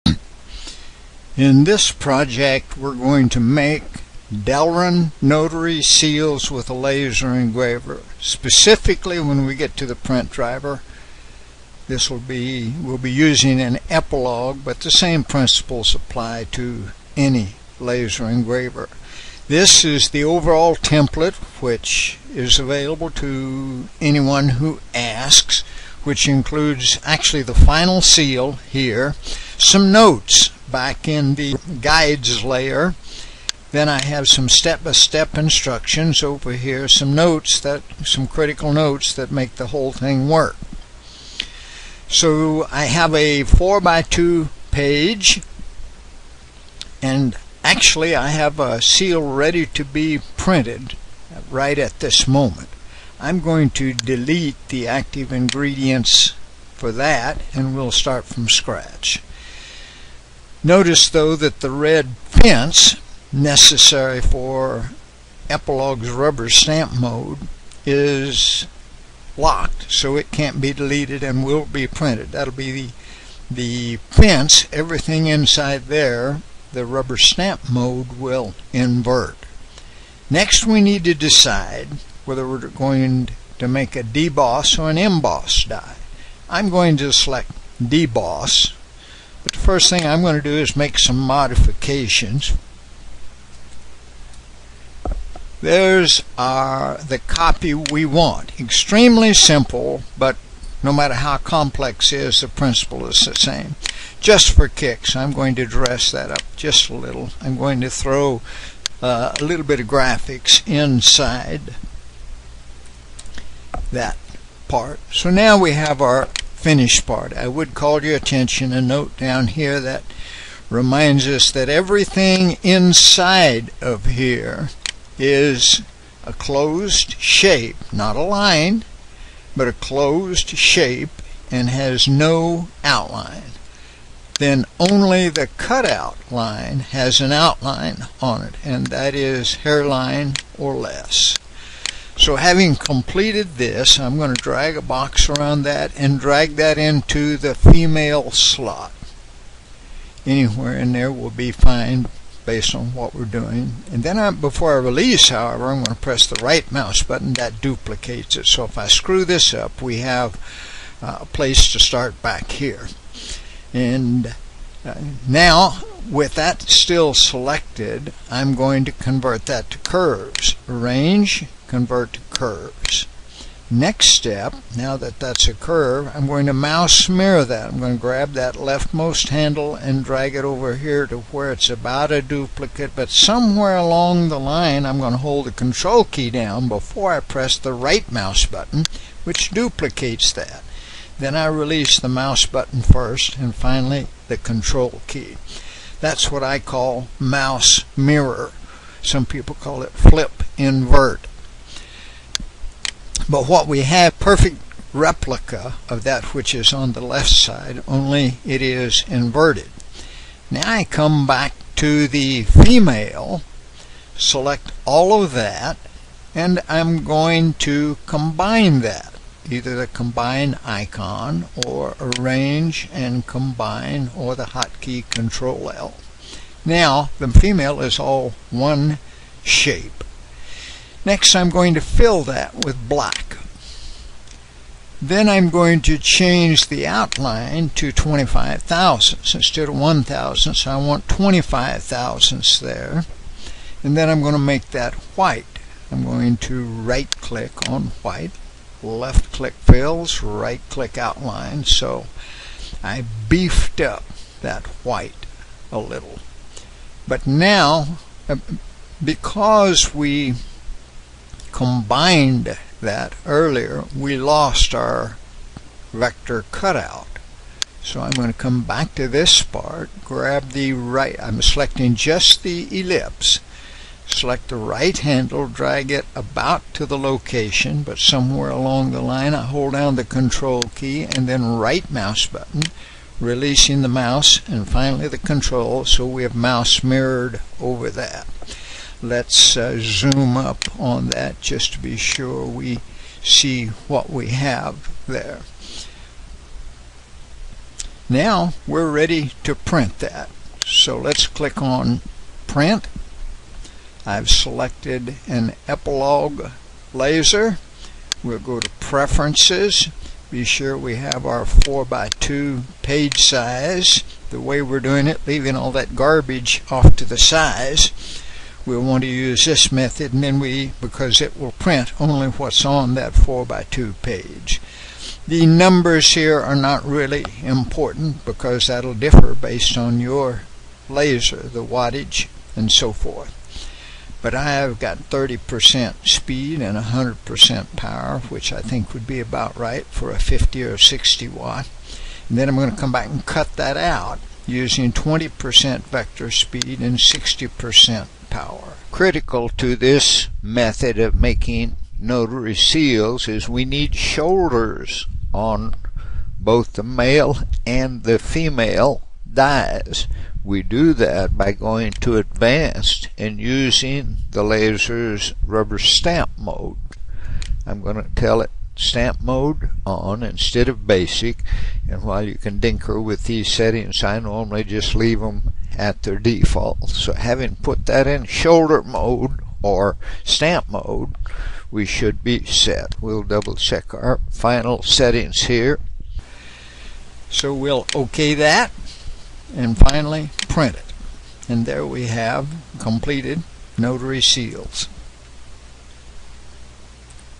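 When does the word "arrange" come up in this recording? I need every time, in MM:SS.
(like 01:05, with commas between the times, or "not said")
02:50, 03:42.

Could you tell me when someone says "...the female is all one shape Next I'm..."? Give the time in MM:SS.
03:47.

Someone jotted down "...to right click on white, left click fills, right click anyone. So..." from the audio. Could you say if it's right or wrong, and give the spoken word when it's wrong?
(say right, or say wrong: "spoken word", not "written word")
wrong: "outline", not "anyone".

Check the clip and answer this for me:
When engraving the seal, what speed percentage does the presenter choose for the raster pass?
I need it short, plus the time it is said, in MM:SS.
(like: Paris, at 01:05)
30%, at 05:35.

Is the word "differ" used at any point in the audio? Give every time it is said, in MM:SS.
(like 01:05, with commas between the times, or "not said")
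05:28.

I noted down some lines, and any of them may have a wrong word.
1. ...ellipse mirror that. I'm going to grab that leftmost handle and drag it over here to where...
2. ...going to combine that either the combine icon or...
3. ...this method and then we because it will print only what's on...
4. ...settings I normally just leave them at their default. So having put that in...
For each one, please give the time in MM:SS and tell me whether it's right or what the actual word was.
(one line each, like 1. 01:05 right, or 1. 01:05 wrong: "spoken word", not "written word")
1. 02:56 wrong: "mouse", not "ellipse"
2. 03:37 right
3. 05:19 right
4. 06:13 right.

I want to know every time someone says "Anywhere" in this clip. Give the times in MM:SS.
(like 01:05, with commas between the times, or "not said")
02:30.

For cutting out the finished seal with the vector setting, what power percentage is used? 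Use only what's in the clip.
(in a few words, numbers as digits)
60%.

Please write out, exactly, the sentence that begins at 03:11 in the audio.
Then I release the mouse button first, and finally the control key.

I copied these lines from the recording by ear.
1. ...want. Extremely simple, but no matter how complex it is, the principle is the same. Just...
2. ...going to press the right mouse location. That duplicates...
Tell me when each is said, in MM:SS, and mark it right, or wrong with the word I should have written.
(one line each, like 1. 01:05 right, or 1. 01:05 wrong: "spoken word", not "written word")
1. 01:38 right
2. 02:35 wrong: "button", not "location".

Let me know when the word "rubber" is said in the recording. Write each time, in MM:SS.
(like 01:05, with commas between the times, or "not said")
01:06, 01:16, 06:05.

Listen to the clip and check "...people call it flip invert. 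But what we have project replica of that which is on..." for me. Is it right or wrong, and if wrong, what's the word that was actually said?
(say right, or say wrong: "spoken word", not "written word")
wrong: "perfect", not "project".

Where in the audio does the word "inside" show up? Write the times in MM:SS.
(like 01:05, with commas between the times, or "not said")
01:15, 01:50, 02:02.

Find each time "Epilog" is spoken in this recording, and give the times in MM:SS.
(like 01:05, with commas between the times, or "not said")
00:13, 01:05, 05:05.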